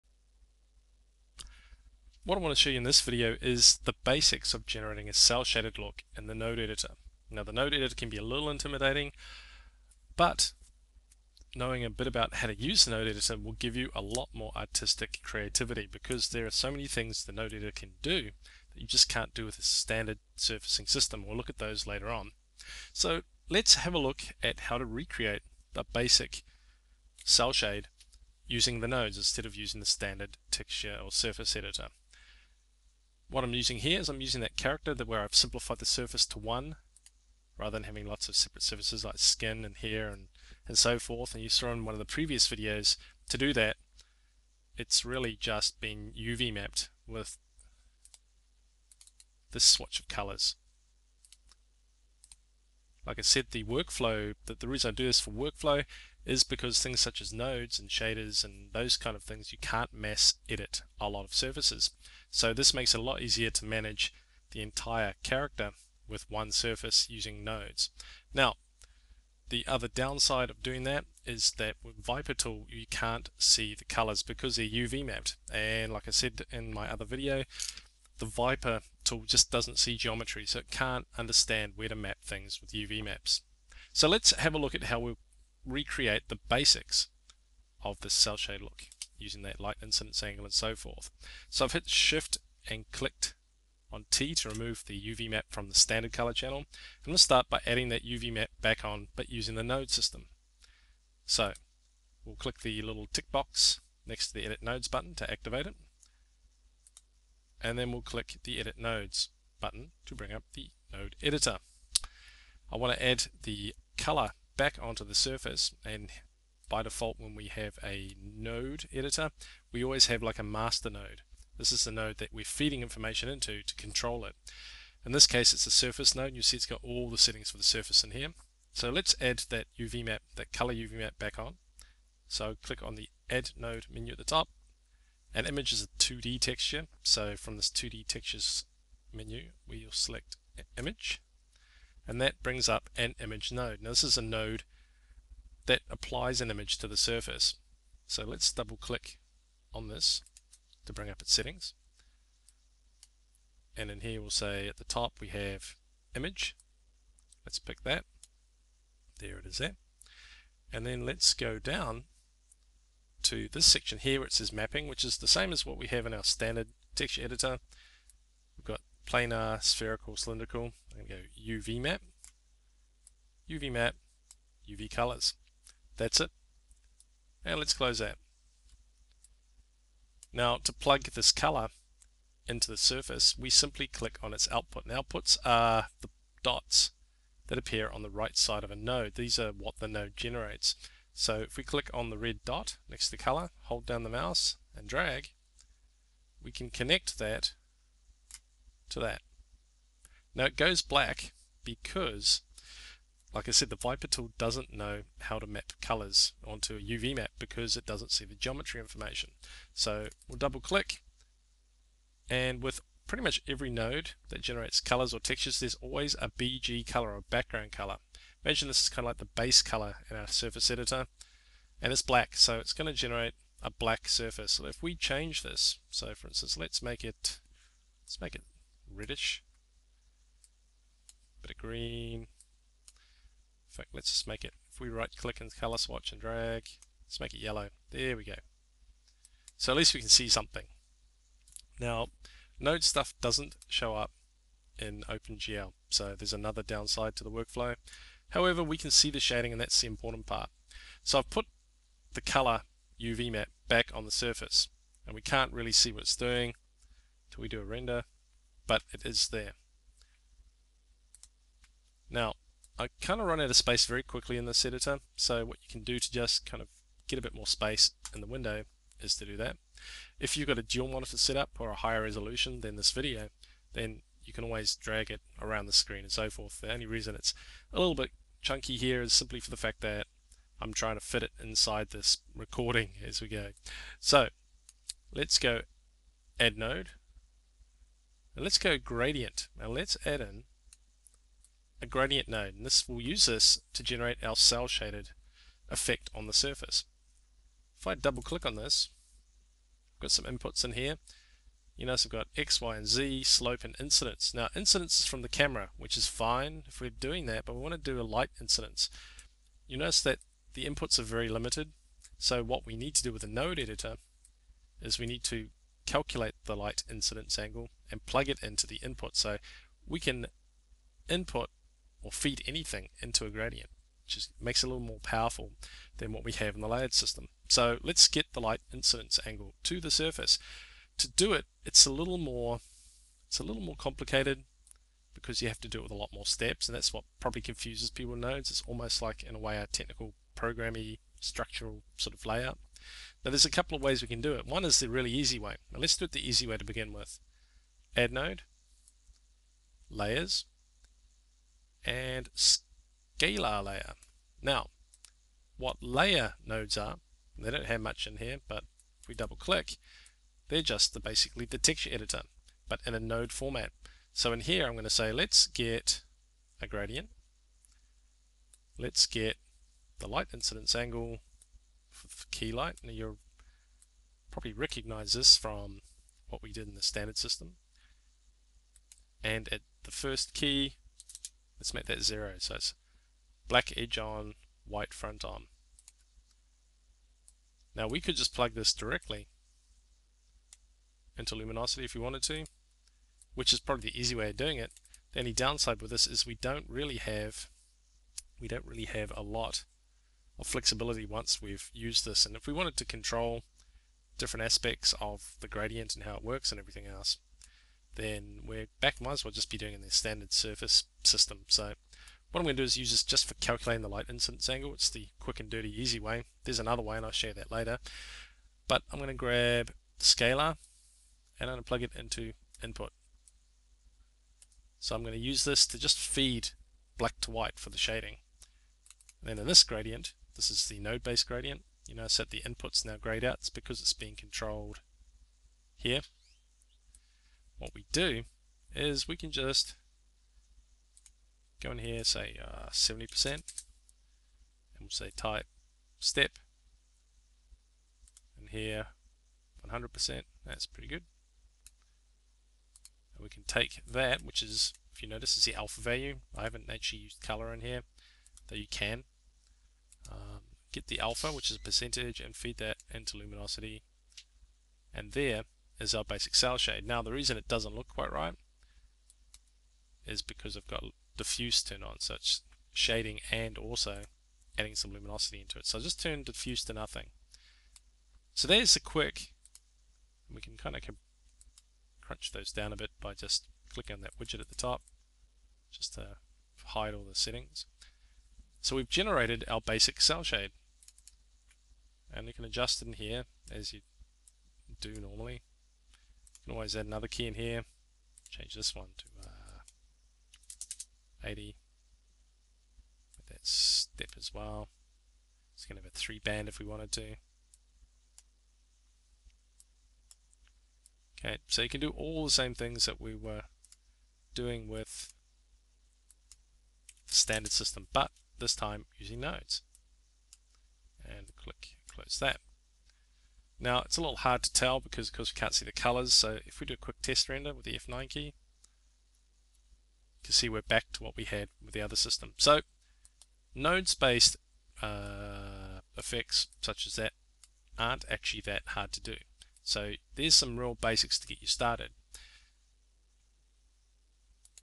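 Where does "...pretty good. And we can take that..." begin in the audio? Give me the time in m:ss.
7:30.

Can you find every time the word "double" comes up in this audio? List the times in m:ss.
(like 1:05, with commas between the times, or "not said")
2:28, 3:30, 4:57, 5:59.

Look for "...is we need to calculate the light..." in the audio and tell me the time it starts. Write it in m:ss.
5:14.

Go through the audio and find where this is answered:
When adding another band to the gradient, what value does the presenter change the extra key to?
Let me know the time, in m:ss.
8:21.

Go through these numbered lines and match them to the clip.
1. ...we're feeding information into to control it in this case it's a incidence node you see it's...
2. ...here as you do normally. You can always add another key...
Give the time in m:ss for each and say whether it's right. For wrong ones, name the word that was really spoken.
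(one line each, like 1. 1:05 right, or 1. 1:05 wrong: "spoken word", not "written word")
1. 2:02 wrong: "surface", not "incidence"
2. 8:12 right.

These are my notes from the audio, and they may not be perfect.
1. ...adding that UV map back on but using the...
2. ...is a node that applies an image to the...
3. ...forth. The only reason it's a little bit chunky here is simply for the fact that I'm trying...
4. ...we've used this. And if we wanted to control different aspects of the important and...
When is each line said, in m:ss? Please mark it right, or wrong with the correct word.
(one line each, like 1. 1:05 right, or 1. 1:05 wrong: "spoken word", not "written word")
1. 1:37 right
2. 2:24 right
3. 4:36 right
4. 6:41 wrong: "gradient", not "important".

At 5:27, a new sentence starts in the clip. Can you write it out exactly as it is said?
So let's get the light incidence angle to the surface.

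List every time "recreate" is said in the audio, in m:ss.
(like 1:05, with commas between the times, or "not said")
0:24, 1:25.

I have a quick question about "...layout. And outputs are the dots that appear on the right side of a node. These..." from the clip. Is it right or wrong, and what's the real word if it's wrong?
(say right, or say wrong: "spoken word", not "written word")
wrong: "output", not "layout".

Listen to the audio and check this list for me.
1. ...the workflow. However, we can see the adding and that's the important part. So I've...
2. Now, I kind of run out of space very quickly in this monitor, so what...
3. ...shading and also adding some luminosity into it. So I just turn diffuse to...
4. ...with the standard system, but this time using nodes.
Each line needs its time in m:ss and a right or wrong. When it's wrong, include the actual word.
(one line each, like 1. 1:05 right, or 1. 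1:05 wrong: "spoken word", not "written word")
1. 4:07 wrong: "shading", not "adding"
2. 4:22 wrong: "editor", not "monitor"
3. 7:52 right
4. 8:34 right.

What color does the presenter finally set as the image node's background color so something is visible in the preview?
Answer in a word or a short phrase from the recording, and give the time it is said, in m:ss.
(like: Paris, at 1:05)
Yellow, at 3:57.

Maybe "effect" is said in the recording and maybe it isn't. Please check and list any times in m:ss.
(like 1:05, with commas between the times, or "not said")
4:55, 8:55.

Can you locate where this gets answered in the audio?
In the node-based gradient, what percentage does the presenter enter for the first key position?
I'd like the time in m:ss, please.
7:22.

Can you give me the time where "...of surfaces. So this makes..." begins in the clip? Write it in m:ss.
1:01.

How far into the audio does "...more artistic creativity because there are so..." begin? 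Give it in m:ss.
0:14.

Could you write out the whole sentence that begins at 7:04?
So I'm going to use this to just feed black to white for the shading.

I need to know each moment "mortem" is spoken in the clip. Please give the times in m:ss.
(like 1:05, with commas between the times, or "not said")
not said.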